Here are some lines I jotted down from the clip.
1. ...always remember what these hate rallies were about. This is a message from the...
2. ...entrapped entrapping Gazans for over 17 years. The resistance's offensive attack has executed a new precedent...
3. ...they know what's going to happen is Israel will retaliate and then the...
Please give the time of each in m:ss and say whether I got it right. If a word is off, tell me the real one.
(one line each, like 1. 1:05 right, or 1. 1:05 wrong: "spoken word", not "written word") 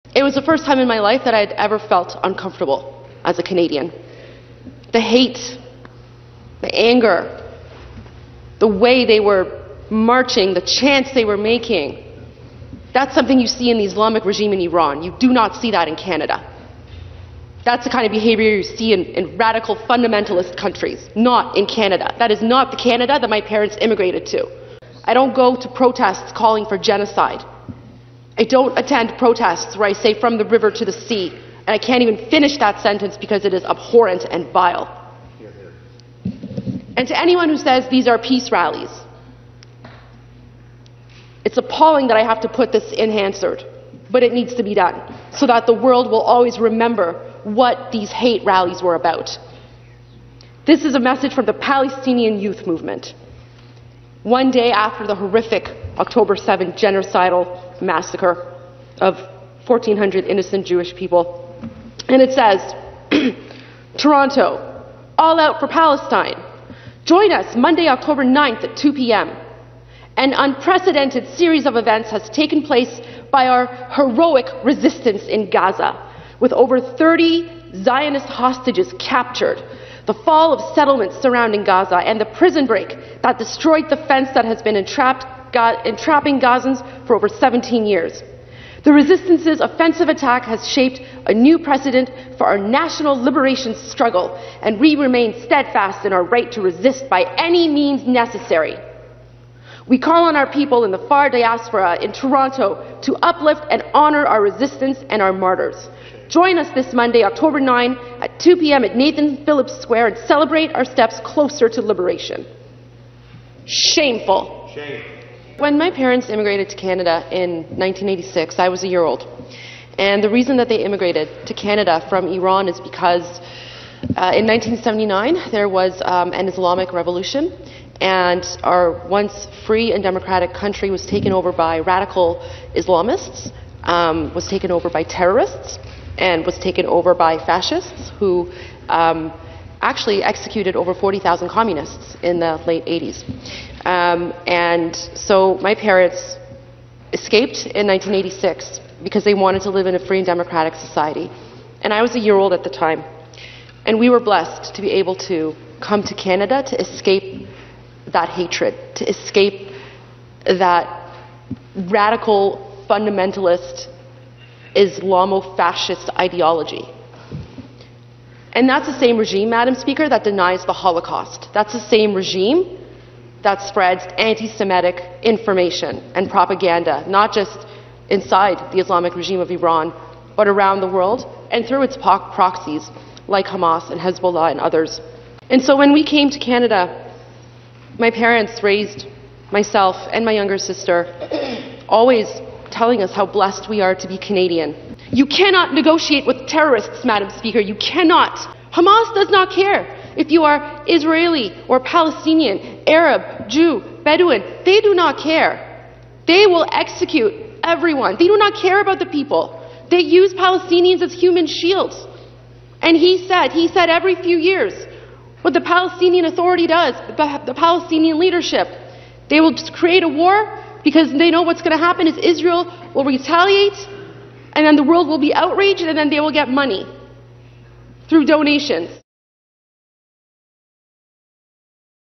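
1. 0:46 right
2. 1:24 wrong: "shaped", not "executed"
3. 3:41 right.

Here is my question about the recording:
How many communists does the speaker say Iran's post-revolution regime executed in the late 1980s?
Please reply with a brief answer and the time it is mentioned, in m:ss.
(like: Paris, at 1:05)
over 40,000, at 2:20.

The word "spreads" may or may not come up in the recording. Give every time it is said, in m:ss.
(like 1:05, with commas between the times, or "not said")
2:53.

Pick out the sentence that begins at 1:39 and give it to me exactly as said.
We call on our people in the far diaspora in Toronto to uplift and honor our resistance and our martyrs.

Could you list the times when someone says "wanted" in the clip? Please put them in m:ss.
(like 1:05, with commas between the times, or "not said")
2:29.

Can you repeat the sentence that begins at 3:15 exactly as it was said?
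You cannot negotiate with terrorists, Madam Speaker.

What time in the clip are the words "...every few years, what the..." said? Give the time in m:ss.
3:33.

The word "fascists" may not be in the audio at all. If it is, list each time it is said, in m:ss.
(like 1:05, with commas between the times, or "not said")
2:17, 2:45.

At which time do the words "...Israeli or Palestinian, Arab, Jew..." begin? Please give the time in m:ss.
3:20.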